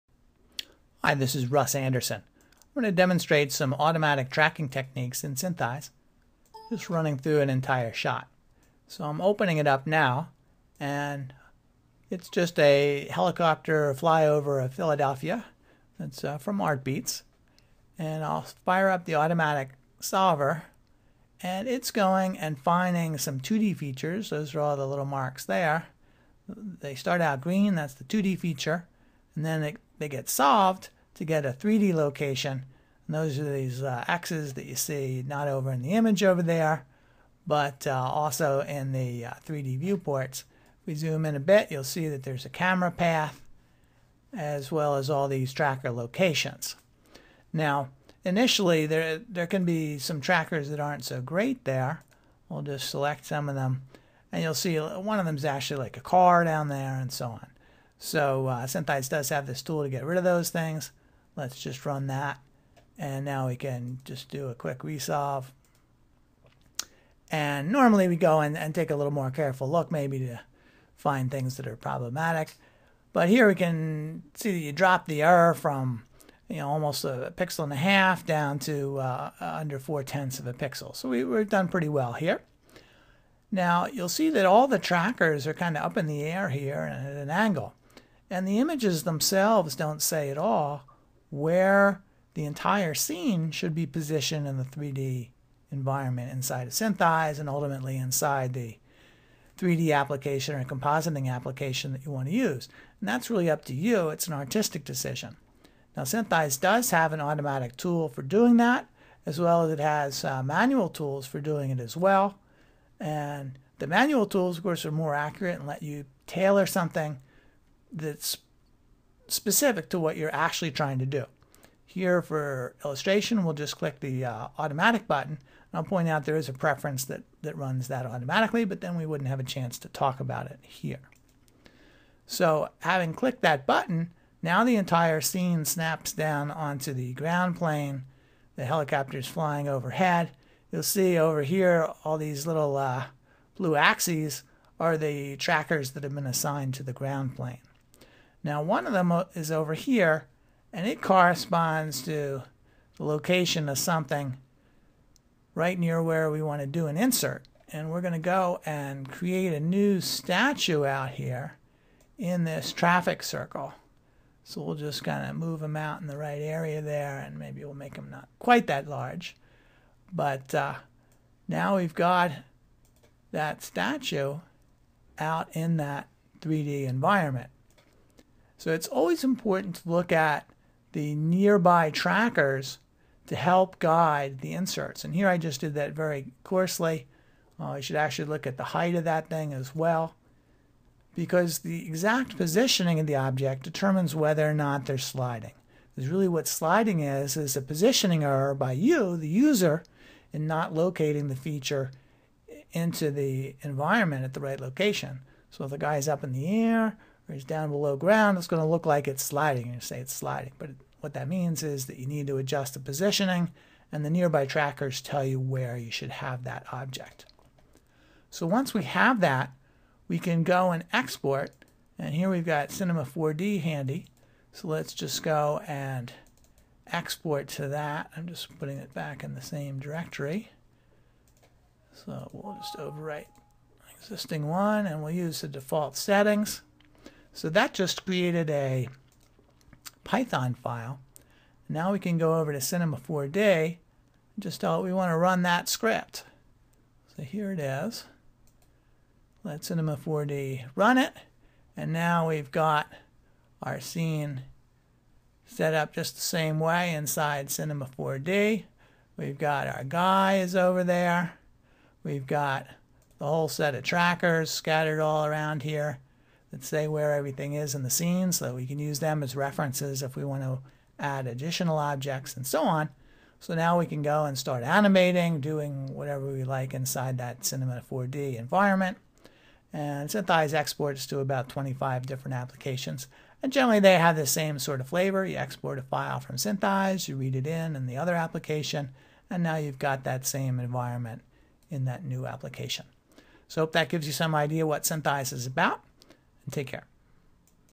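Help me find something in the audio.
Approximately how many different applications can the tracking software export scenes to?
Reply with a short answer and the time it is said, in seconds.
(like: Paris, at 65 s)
about 25, at 281 s.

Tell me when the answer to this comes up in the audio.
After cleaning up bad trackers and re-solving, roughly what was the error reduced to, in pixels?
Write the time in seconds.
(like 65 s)
79 s.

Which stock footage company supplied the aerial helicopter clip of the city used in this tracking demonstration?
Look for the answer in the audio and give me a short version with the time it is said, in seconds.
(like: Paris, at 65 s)
Artbeats, at 16 s.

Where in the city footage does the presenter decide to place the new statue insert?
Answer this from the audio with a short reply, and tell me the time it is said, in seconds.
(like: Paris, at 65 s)
traffic circle, at 162 s.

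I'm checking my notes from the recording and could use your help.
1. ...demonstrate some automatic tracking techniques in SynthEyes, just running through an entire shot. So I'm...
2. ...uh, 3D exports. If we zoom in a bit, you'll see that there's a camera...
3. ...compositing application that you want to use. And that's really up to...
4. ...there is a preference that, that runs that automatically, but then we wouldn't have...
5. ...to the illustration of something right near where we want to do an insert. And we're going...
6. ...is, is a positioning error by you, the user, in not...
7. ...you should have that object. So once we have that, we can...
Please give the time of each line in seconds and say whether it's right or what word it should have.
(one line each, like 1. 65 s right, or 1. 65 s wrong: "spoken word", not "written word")
1. 2 s right
2. 39 s wrong: "viewports", not "exports"
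3. 100 s right
4. 126 s right
5. 152 s wrong: "location", not "illustration"
6. 196 s right
7. 215 s right.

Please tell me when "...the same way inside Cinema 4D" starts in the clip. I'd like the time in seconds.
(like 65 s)
256 s.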